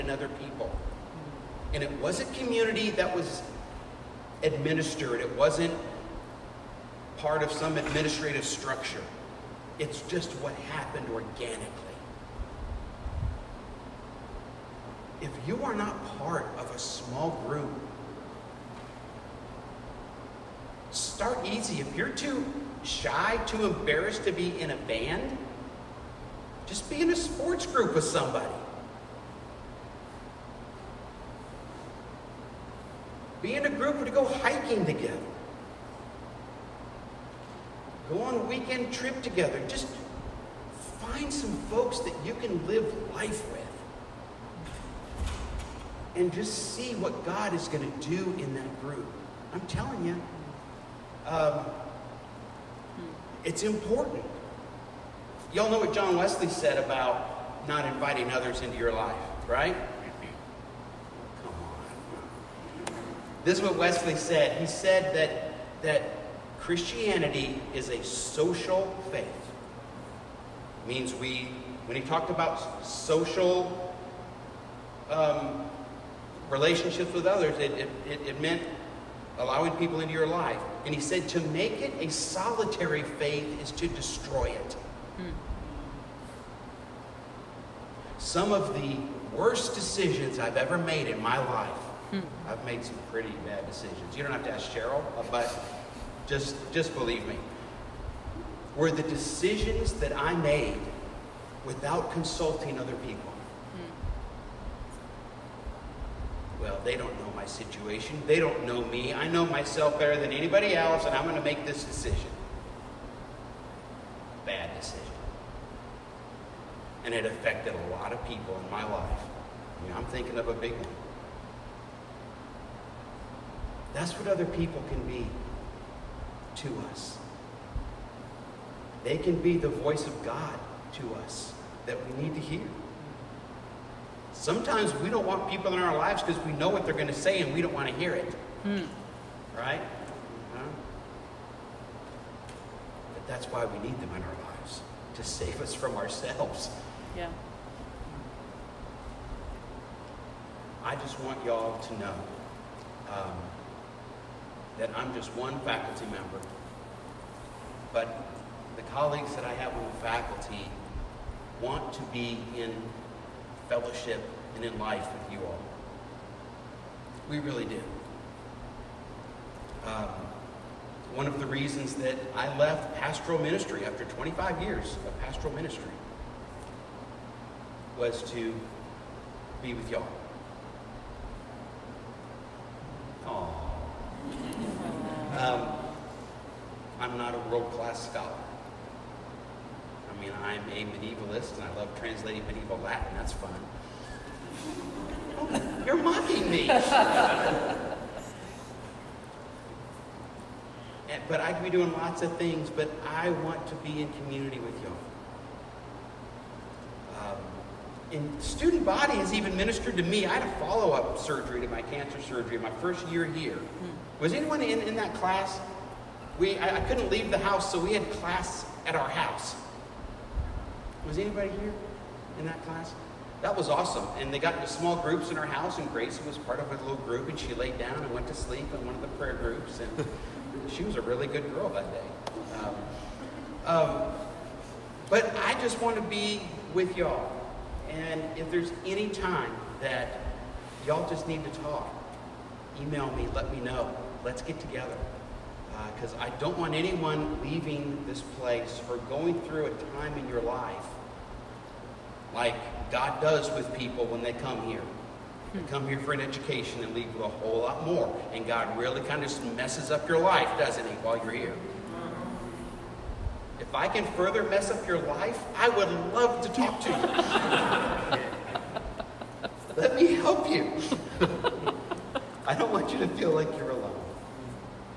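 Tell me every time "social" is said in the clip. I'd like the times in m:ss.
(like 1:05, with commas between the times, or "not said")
1:08, 1:12.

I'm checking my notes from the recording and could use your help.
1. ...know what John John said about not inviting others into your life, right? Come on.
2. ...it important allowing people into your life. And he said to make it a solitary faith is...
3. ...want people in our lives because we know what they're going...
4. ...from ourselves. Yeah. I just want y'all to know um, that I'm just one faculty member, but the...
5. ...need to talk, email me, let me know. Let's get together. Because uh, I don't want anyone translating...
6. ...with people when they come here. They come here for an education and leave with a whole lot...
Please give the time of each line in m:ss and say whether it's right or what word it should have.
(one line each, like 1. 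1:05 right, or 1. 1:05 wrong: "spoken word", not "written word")
1. 0:55 wrong: "Wesley", not "John"
2. 1:18 wrong: "meant", not "important"
3. 2:15 right
4. 2:25 right
5. 4:01 wrong: "leaving", not "translating"
6. 4:13 right.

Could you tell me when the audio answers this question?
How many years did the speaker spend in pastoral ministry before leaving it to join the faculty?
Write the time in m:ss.
2:54.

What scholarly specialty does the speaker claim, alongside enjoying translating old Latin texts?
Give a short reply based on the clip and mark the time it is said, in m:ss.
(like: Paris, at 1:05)
Medievalist, at 3:10.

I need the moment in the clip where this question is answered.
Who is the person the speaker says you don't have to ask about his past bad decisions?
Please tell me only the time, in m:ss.
1:34.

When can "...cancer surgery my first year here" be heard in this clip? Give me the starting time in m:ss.
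3:31.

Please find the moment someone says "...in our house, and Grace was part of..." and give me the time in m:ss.
3:45.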